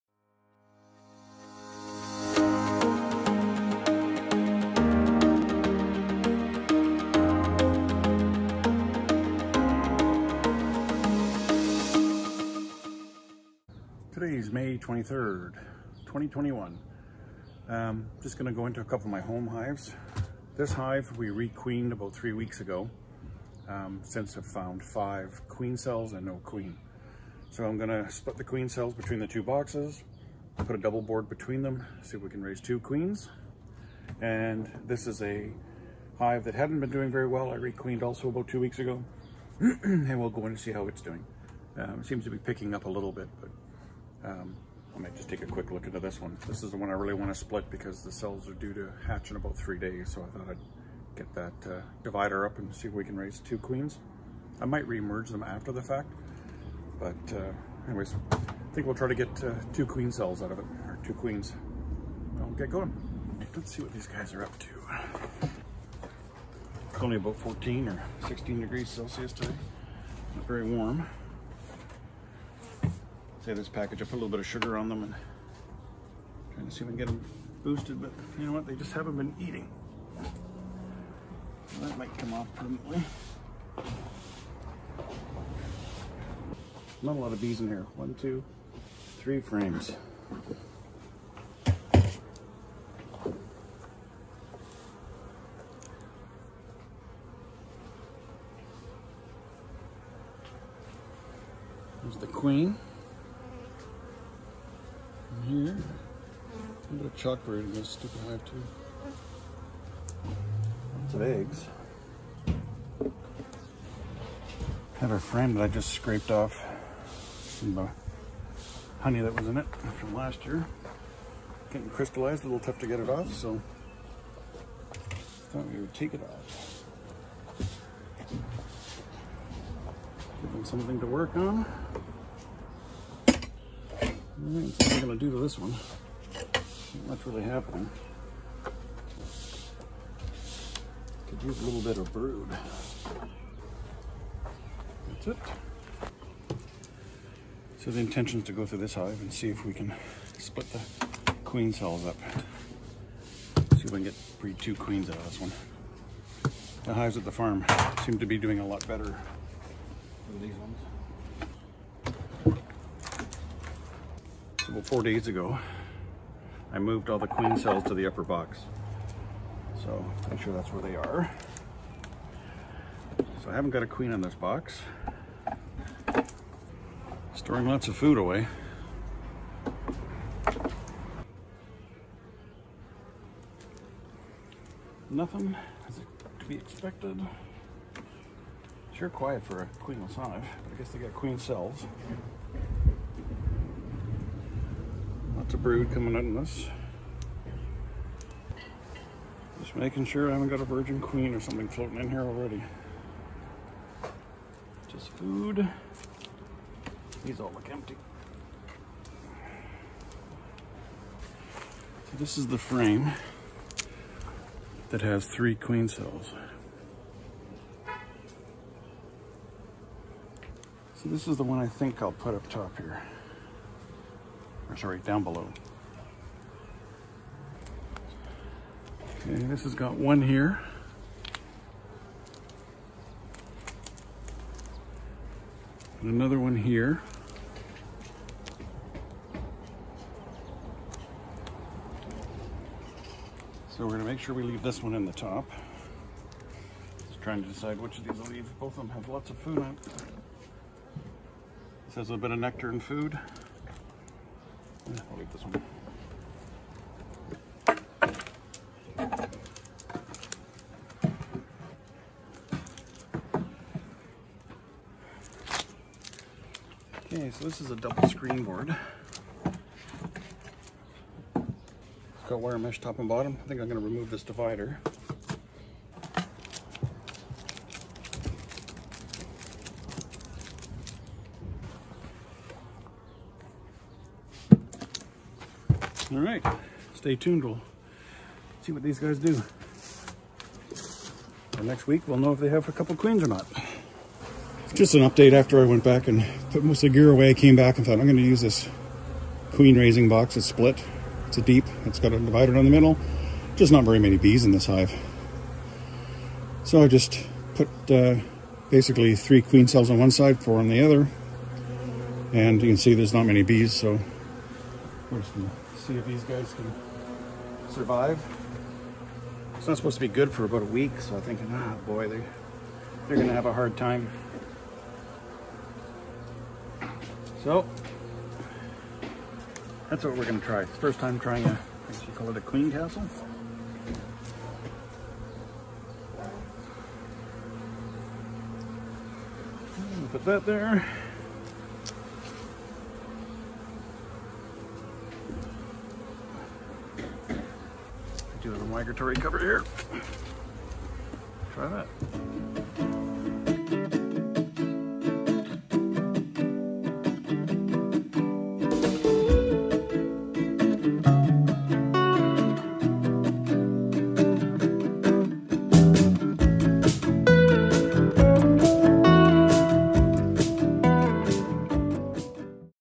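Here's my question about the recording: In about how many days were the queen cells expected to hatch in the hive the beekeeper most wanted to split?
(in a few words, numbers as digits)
3.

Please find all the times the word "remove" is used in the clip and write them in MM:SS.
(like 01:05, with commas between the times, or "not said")
04:33.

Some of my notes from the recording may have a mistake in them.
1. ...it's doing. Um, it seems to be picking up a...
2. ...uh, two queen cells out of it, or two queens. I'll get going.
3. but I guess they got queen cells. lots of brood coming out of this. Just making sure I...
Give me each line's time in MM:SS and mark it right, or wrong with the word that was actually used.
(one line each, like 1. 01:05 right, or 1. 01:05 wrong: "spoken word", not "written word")
1. 00:40 right
2. 00:59 right
3. 03:10 right.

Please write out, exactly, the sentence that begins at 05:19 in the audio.
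It's not supposed to be good for about a week, so I think, ah, boy, they're, they're gonna have a hard time.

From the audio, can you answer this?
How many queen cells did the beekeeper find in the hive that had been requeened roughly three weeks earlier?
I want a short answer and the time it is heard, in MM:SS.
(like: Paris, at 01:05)
5, at 00:24.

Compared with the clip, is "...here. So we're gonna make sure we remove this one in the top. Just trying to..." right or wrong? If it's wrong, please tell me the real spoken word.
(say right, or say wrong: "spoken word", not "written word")
wrong: "leave", not "remove".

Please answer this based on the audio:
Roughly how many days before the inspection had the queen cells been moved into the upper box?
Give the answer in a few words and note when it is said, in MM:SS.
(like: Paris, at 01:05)
4, at 02:44.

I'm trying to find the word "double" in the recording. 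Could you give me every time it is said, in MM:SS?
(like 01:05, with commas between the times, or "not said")
00:30, 04:27.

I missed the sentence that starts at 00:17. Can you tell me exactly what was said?
Um, just gonna go into a couple of my home hives.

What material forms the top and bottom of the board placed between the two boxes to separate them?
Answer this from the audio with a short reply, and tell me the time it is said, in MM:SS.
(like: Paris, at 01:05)
wire mesh, at 04:32.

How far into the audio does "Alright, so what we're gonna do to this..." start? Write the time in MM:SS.
02:14.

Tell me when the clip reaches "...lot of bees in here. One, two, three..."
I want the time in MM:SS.
01:27.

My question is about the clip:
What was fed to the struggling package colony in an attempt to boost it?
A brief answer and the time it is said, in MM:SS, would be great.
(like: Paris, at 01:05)
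sugar, at 01:14.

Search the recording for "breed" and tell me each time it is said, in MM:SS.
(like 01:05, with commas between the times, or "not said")
02:34.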